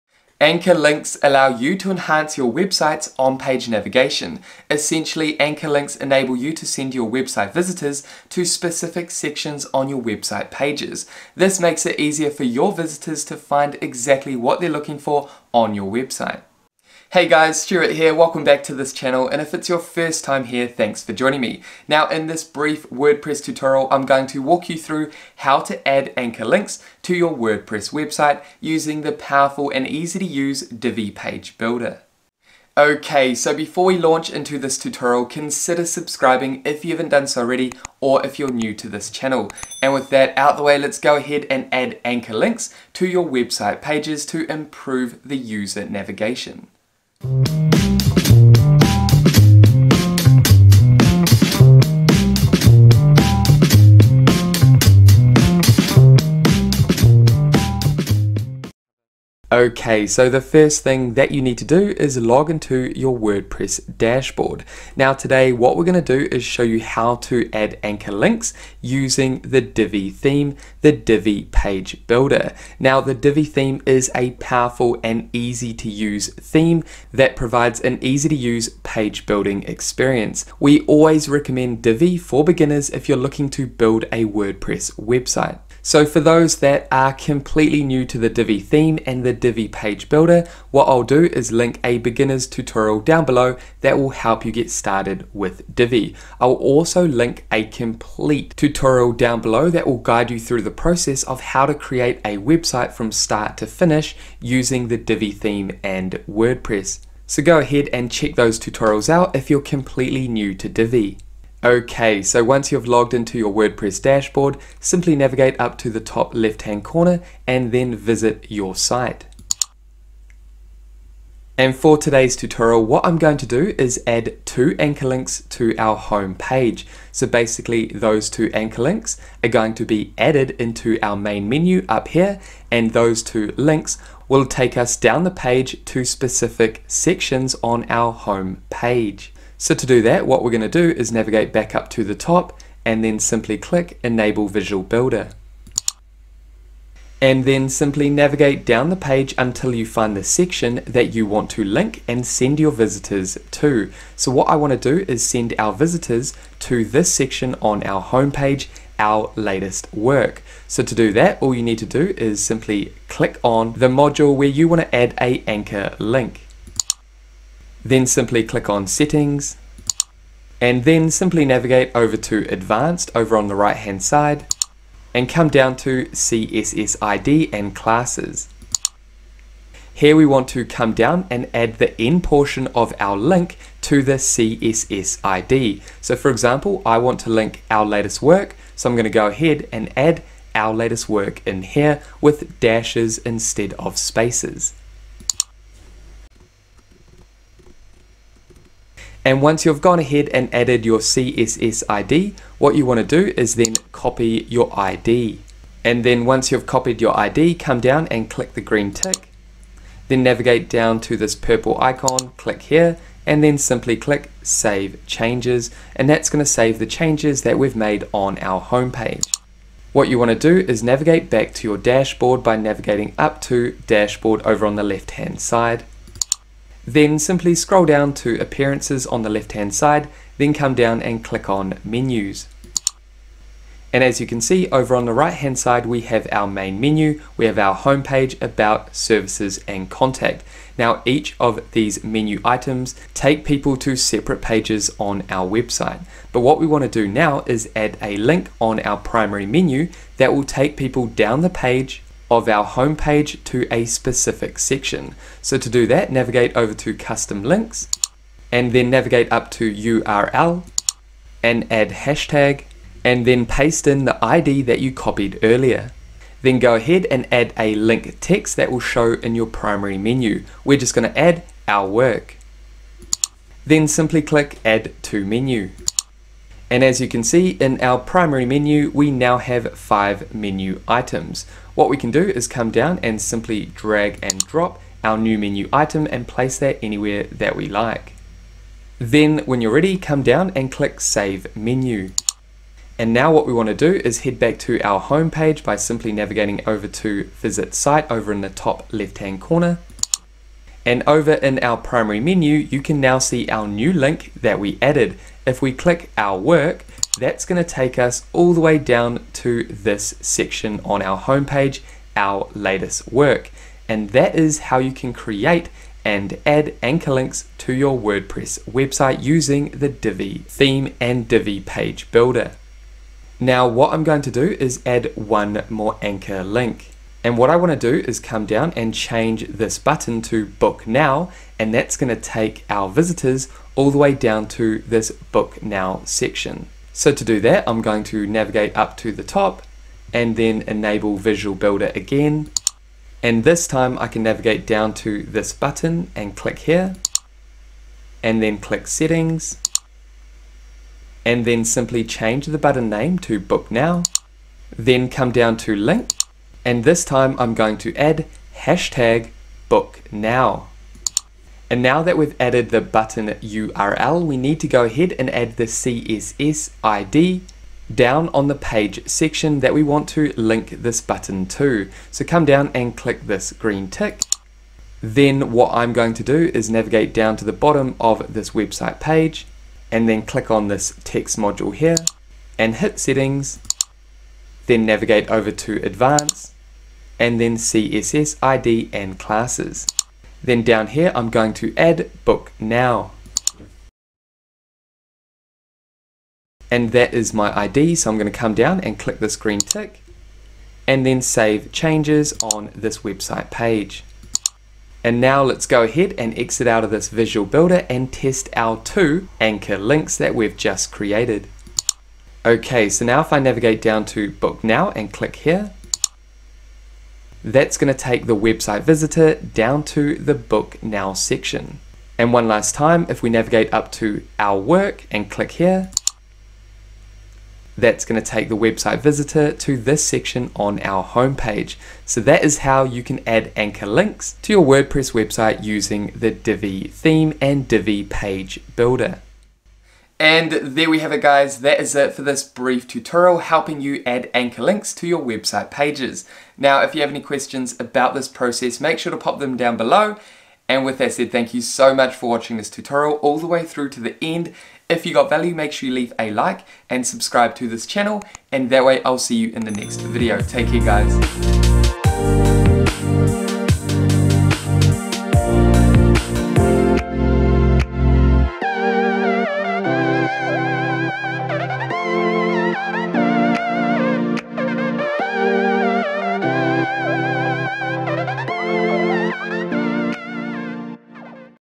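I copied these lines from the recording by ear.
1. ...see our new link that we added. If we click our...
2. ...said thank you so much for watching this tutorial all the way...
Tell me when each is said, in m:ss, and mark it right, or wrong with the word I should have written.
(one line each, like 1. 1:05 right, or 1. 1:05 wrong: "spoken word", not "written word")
1. 5:03 right
2. 7:31 right.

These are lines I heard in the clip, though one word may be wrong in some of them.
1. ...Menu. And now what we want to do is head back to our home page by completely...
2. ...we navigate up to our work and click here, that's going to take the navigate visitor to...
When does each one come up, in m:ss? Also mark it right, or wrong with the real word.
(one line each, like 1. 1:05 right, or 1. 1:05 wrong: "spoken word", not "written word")
1. 4:51 wrong: "simply", not "completely"
2. 7:03 wrong: "website", not "navigate".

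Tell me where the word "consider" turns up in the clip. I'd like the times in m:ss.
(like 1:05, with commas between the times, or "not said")
0:35.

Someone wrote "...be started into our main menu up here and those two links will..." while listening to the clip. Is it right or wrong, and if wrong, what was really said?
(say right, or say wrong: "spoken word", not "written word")
wrong: "added", not "started".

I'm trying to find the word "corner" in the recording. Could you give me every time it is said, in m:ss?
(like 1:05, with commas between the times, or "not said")
1:56, 4:59.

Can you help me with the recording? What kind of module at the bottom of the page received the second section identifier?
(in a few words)
text module.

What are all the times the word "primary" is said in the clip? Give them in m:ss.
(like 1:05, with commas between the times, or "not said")
4:08, 4:29, 4:37, 5:01.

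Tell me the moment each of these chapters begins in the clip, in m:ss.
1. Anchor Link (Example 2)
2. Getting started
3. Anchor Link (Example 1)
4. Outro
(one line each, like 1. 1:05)
1. 5:25
2. 1:02
3. 2:18
4. 7:20.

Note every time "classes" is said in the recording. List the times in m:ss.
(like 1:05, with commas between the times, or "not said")
2:57, 6:29.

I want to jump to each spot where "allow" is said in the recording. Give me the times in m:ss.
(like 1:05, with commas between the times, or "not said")
0:01.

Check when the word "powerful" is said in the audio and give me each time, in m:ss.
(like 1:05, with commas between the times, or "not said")
0:29, 1:14.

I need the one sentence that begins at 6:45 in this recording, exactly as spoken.
And now let's go ahead and exit out of this visual builder and test our two anchor links that we've just created.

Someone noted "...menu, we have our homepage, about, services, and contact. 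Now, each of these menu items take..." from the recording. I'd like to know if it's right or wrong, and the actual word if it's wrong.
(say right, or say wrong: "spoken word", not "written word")
right.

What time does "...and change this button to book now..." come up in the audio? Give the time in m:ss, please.
5:28.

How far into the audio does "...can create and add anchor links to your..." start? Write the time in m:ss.
5:14.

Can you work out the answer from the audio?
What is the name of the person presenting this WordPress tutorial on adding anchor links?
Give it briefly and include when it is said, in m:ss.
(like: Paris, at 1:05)
Stewart, at 0:17.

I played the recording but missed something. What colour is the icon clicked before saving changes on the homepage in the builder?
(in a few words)
purple.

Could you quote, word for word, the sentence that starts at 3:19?
And once you've gone ahead and added your CSS ID, what you want to do is then copy your ID.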